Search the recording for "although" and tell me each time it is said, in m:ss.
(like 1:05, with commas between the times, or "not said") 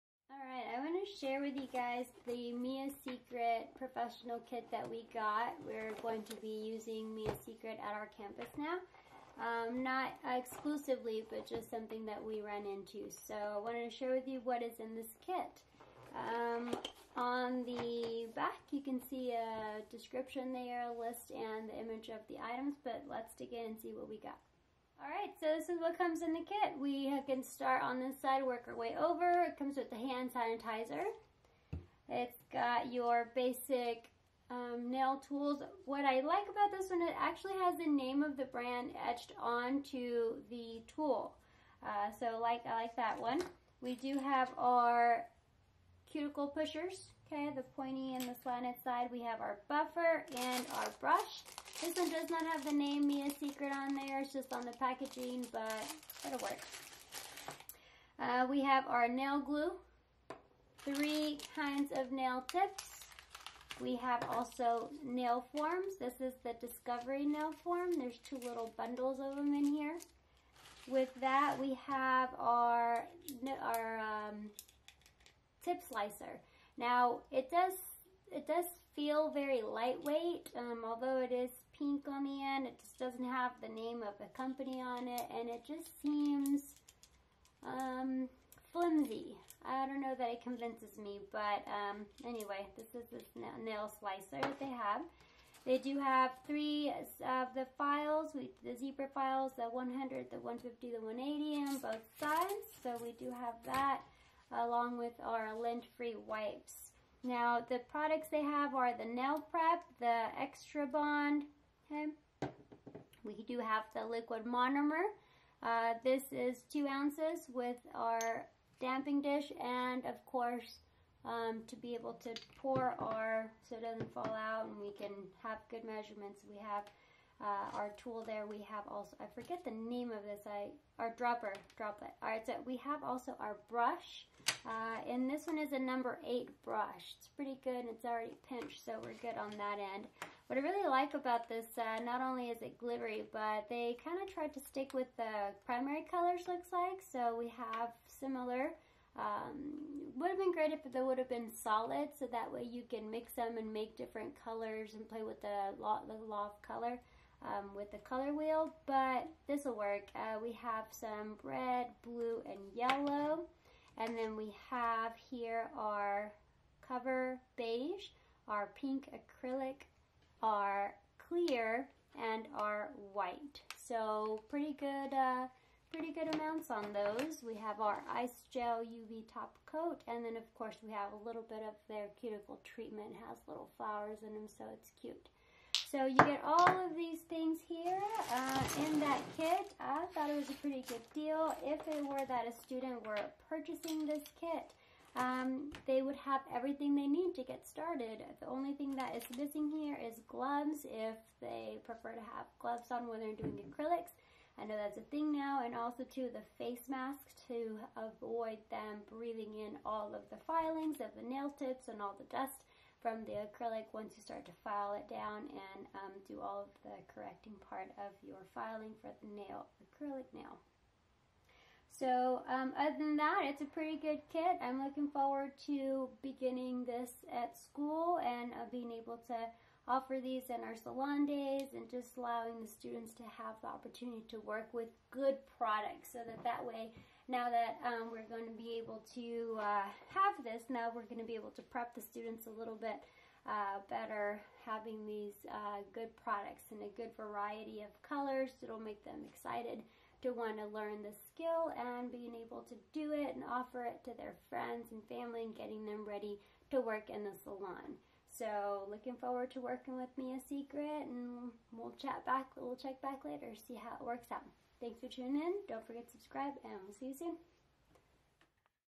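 1:20.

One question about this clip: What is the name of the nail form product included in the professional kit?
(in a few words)
Discovery.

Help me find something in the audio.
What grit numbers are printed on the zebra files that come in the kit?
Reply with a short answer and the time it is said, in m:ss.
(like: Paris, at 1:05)
100, 150, 180, at 1:39.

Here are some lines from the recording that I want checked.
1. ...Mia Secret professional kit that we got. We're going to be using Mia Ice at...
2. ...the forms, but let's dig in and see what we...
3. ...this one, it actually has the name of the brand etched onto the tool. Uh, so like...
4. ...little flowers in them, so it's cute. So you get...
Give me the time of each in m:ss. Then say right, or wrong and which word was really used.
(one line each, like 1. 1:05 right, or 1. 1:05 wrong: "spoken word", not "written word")
1. 0:02 wrong: "Secret", not "Ice"
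2. 0:22 wrong: "items", not "forms"
3. 0:36 right
4. 3:03 right.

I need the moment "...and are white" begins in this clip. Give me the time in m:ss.
2:52.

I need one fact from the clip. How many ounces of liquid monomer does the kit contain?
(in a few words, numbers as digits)
2.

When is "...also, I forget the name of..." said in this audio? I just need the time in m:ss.
2:08.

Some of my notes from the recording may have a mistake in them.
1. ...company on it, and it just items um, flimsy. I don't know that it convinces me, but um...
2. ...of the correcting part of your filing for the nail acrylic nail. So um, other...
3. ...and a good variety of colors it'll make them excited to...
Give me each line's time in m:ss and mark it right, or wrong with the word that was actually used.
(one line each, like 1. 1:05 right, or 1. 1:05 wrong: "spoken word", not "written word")
1. 1:24 wrong: "seems", not "items"
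2. 3:36 right
3. 4:06 right.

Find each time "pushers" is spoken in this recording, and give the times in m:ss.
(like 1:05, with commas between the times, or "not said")
0:46.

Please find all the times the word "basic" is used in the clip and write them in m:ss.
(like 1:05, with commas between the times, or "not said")
0:33.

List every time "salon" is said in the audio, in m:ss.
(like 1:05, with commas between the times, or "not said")
3:50, 4:17.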